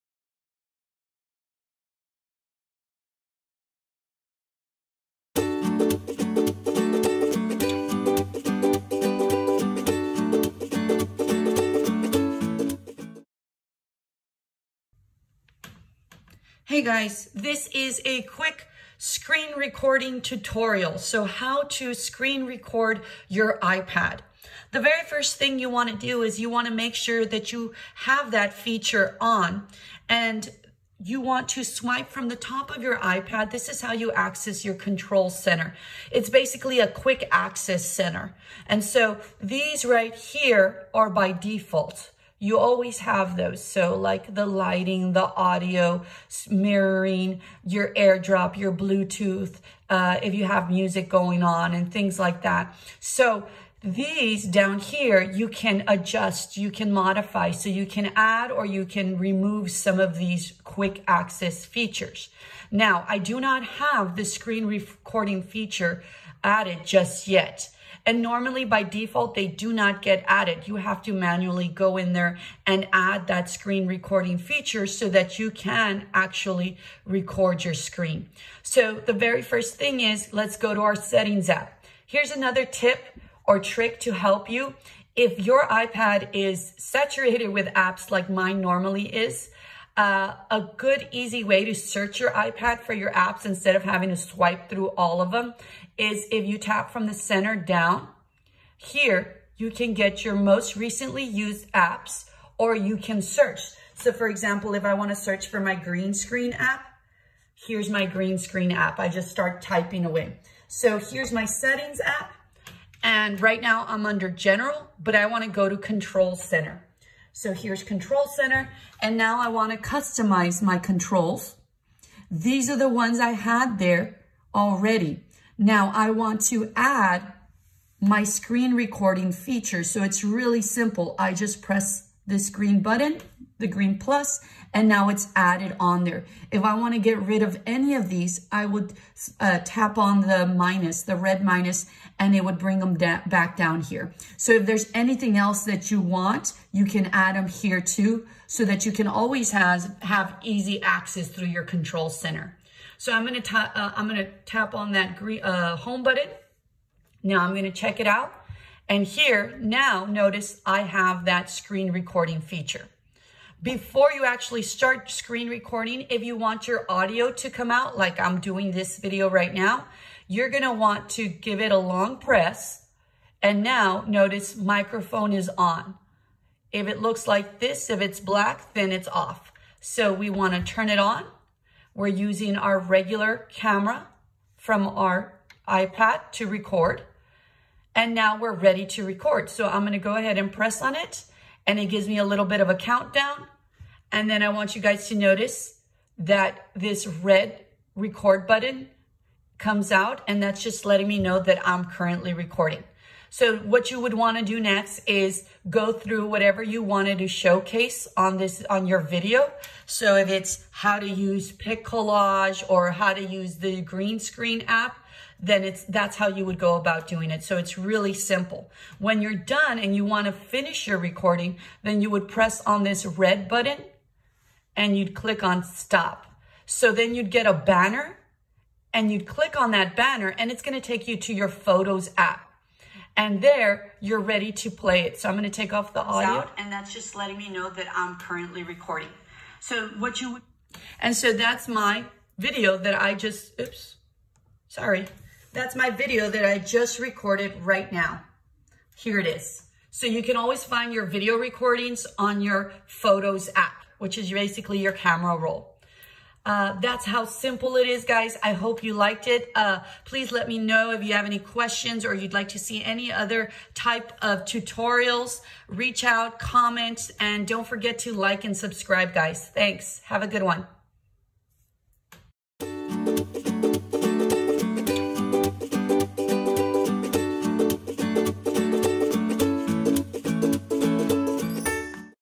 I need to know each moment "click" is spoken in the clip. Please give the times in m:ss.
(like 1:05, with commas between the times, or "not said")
3:45, 3:49.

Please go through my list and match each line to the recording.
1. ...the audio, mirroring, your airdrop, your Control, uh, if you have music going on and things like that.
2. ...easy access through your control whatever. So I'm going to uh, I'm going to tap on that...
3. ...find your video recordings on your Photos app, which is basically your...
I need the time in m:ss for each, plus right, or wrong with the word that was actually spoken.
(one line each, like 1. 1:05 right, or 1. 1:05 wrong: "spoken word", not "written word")
1. 0:45 wrong: "Bluetooth", not "Control"
2. 2:30 wrong: "center", not "whatever"
3. 4:10 right.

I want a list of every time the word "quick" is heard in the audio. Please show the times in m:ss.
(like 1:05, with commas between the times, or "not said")
0:18, 0:36, 1:00.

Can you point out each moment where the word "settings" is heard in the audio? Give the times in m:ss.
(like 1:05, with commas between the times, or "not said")
1:20, 1:51.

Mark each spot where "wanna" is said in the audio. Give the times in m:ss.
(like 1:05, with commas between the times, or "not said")
1:44, 1:55, 3:00.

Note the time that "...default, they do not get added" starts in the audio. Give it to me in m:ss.
1:08.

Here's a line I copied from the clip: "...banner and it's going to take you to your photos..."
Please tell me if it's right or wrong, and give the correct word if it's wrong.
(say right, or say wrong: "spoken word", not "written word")
right.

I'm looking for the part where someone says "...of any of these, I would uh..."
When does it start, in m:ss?
2:17.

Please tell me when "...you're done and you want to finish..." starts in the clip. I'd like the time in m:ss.
3:39.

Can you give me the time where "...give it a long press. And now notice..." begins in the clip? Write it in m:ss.
2:51.